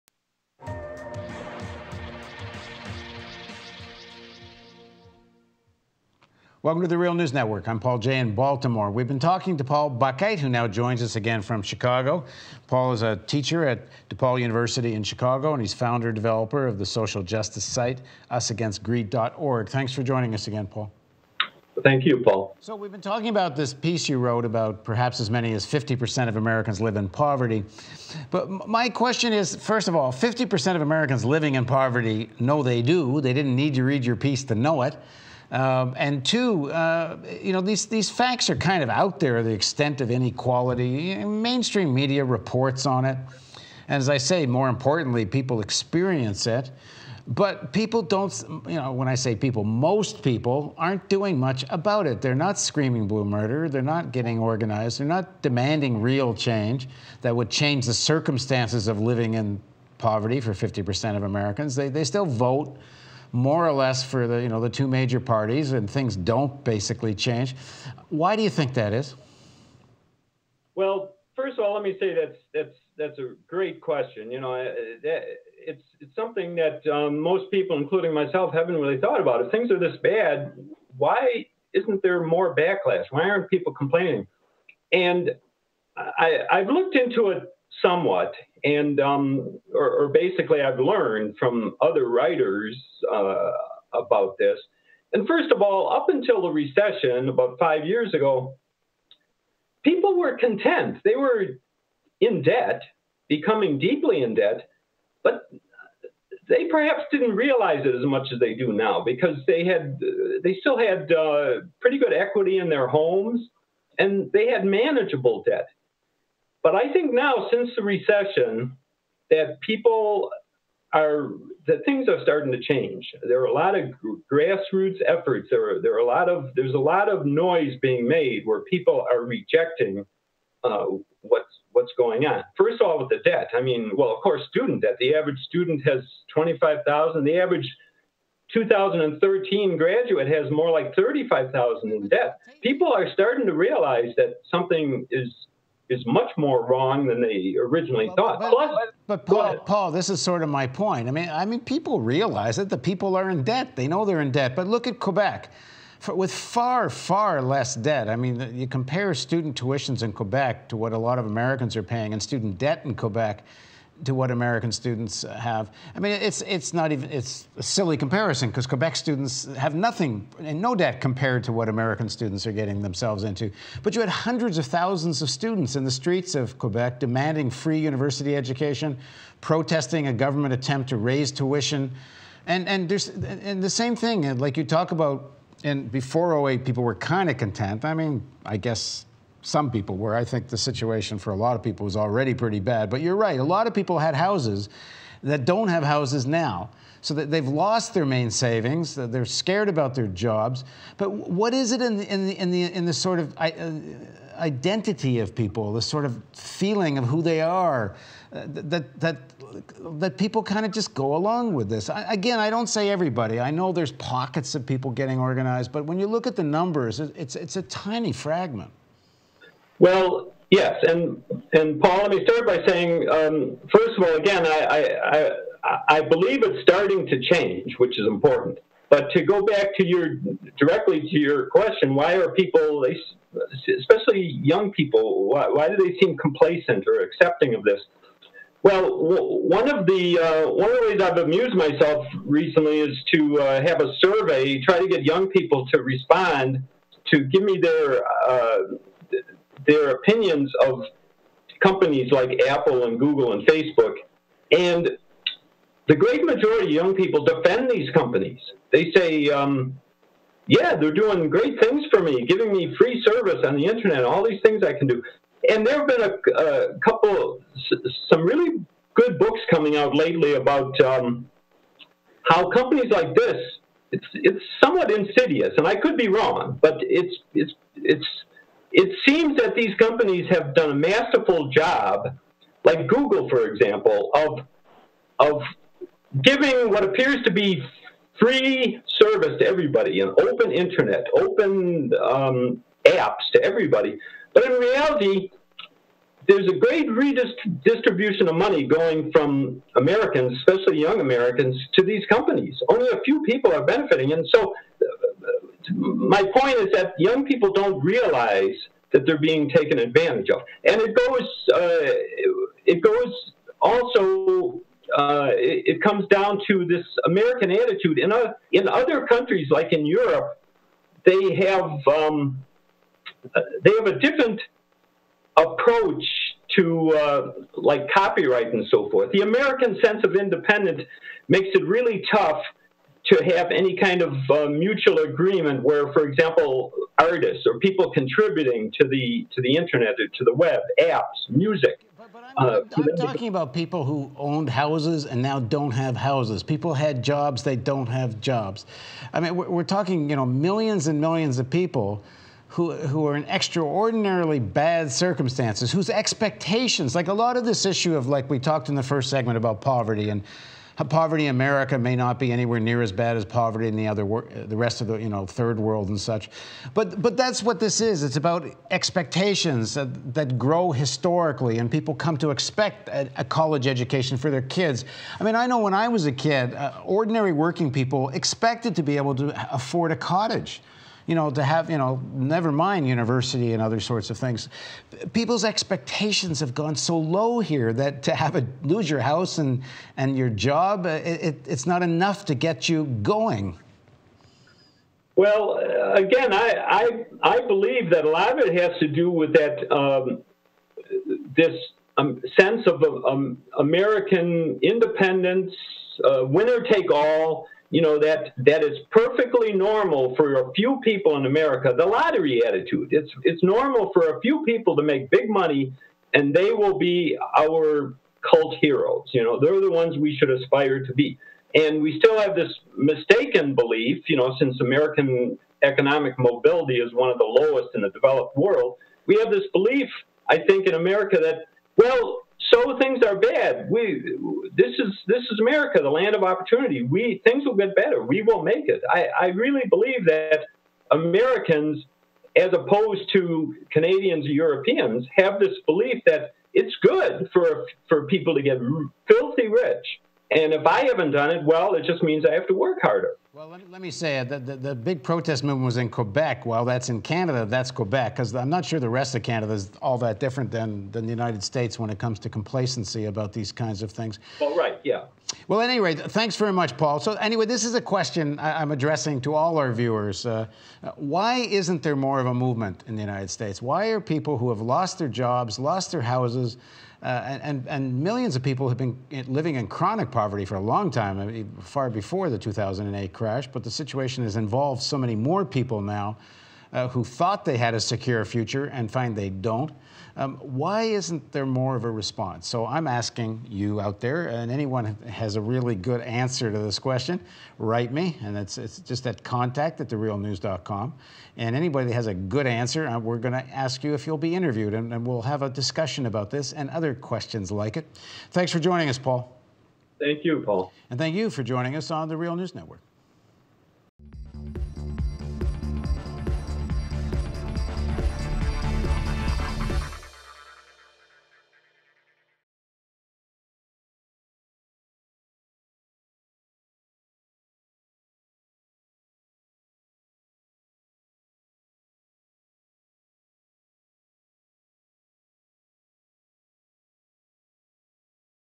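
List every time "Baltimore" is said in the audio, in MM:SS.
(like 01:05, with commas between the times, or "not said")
00:08.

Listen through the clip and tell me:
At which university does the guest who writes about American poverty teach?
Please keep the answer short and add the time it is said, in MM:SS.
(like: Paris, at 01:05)
DePaul University, at 00:14.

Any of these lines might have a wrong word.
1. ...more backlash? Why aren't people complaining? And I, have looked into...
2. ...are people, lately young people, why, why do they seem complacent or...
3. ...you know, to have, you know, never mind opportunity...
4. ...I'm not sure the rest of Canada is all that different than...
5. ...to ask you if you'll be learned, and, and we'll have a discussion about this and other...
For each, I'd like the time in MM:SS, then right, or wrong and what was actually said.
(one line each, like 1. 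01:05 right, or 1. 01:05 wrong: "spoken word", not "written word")
1. 01:22 right
2. 03:52 wrong: "especially", not "lately"
3. 06:21 wrong: "university", not "opportunity"
4. 07:38 right
5. 08:23 wrong: "interviewed", not "learned".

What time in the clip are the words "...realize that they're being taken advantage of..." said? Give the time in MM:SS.
05:07.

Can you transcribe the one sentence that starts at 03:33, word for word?
I know there's pockets of people getting organized, but when you look at the numbers, it's, it's a tiny fragment.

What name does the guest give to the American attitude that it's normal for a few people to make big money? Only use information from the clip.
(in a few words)
the lottery attitude.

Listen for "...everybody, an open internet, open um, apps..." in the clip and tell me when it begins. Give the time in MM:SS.
04:49.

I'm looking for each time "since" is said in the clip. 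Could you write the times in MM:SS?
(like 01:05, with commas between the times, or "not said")
01:57, 07:04.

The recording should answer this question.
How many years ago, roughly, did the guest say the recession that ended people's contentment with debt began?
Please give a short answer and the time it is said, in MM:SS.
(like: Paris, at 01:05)
5, at 01:37.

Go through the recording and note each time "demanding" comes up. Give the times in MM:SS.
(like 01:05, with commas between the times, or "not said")
00:55, 02:56.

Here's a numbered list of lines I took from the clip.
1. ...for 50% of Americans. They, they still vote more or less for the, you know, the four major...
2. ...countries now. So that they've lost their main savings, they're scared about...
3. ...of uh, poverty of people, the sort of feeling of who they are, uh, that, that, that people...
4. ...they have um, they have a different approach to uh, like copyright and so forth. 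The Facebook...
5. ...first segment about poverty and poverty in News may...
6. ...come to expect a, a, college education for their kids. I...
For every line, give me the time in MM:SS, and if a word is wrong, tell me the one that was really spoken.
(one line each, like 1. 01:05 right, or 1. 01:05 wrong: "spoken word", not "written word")
1. 01:00 wrong: "two", not "four"
2. 03:15 wrong: "houses", not "countries"
3. 03:23 wrong: "identity", not "poverty"
4. 05:21 wrong: "American", not "Facebook"
5. 05:58 wrong: "America", not "News"
6. 06:11 right.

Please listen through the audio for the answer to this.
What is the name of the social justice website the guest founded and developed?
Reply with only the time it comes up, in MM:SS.
00:18.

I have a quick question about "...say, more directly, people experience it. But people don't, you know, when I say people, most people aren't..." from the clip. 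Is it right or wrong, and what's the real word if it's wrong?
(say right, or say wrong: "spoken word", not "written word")
wrong: "importantly", not "directly".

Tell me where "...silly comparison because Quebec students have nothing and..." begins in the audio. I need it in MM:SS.
02:47.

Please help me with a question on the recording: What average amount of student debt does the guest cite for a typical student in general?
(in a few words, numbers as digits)
$25,000.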